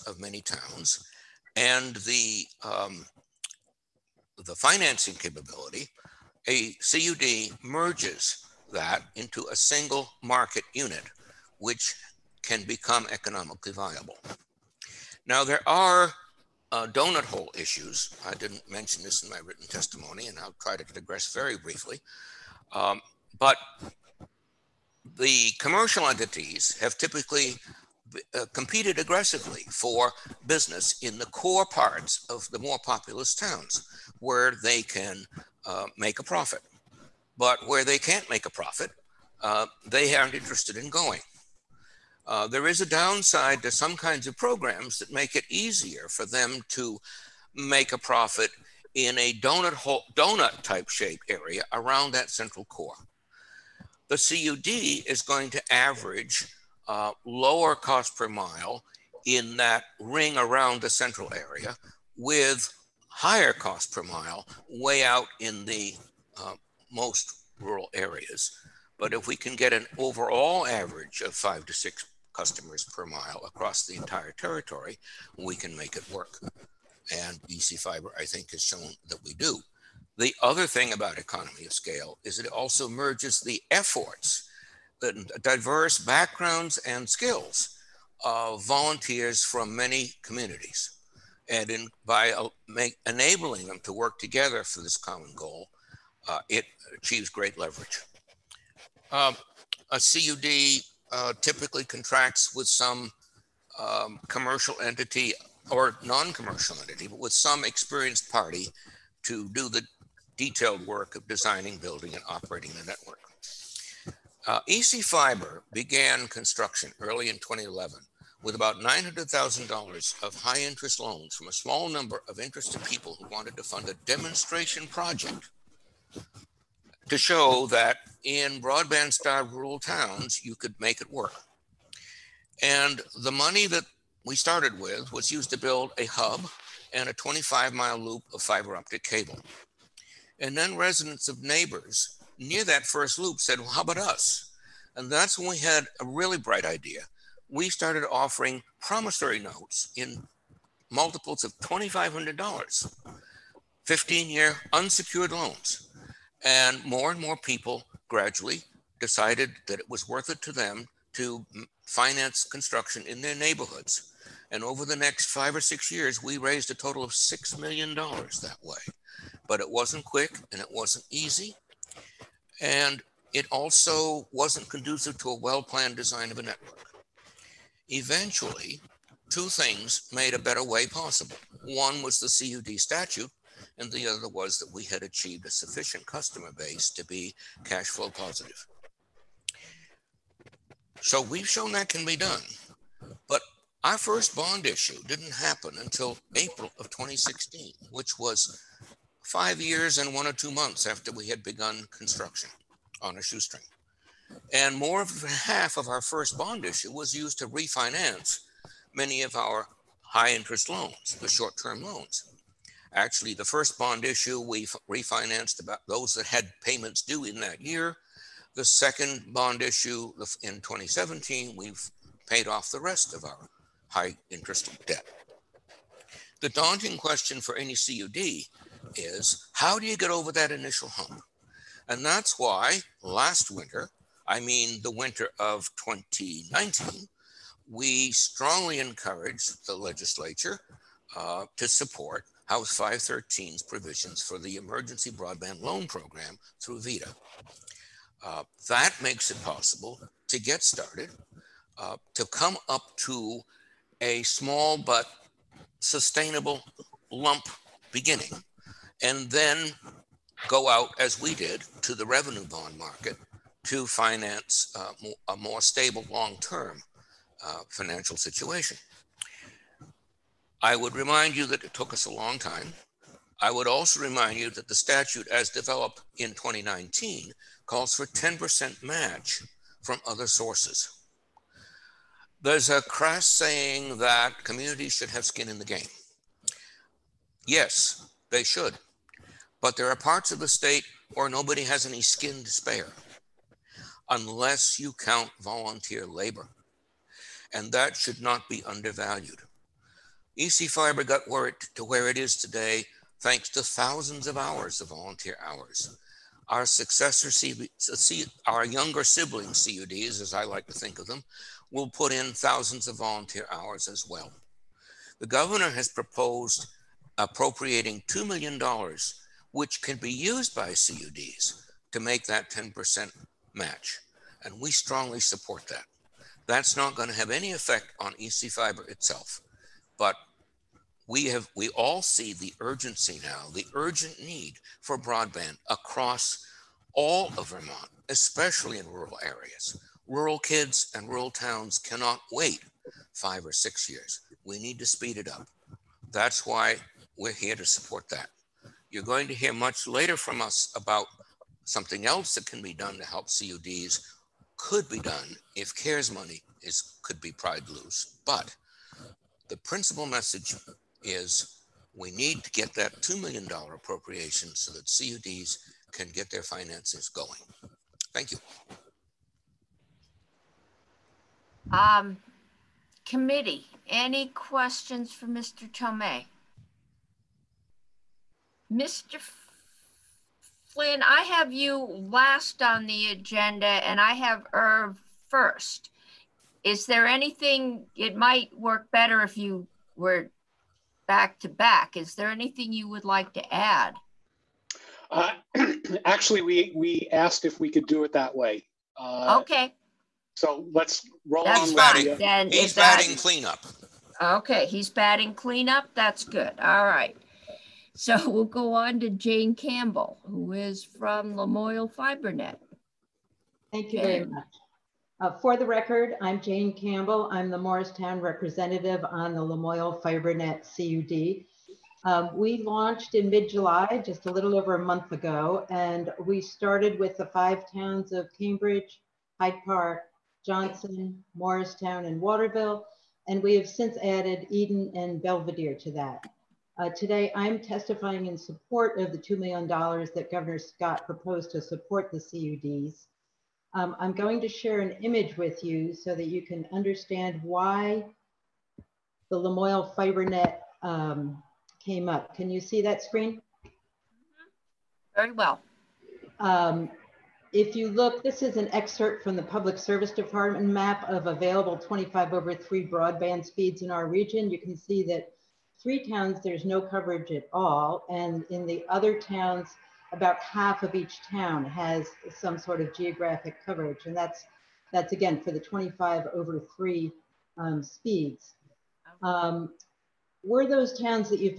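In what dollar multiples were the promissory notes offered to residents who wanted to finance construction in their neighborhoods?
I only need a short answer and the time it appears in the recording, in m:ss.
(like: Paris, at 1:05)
$2,500, at 2:31.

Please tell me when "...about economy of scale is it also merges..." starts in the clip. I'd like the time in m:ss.
1:20.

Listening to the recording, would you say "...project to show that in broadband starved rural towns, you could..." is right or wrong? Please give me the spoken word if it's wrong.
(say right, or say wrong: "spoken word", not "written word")
right.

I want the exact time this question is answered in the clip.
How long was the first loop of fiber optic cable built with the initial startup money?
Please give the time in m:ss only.
2:17.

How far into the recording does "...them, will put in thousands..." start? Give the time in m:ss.
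5:11.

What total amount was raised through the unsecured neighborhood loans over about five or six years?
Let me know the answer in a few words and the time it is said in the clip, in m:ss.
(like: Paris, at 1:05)
$6 million, at 2:47.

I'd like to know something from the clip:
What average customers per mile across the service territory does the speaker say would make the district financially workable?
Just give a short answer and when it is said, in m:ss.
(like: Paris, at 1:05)
5 to 6, at 1:11.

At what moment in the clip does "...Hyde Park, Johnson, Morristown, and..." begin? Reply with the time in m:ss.
7:09.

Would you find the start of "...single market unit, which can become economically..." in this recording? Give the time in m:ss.
0:09.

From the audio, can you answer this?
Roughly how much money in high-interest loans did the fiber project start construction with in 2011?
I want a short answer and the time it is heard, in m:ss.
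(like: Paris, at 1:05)
$900,000, at 1:58.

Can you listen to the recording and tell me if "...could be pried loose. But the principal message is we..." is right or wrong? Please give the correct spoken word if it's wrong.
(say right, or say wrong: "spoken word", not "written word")
right.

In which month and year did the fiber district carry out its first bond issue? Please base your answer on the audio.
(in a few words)
April 2016.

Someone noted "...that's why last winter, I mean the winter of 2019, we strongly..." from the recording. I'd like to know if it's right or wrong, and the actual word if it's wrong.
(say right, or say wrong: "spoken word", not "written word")
right.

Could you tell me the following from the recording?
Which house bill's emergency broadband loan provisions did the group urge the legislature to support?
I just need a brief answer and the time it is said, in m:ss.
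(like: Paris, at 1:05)
House 513, at 4:02.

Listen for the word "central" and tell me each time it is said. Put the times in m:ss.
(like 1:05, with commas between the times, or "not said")
0:52, 1:00.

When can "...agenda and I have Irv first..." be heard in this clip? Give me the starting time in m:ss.
6:23.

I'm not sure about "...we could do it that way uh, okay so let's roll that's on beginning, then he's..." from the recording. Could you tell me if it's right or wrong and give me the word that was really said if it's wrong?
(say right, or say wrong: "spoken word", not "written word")
wrong: "batting", not "beginning".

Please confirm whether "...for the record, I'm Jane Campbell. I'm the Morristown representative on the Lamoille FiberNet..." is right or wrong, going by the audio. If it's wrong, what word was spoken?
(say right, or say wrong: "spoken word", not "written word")
right.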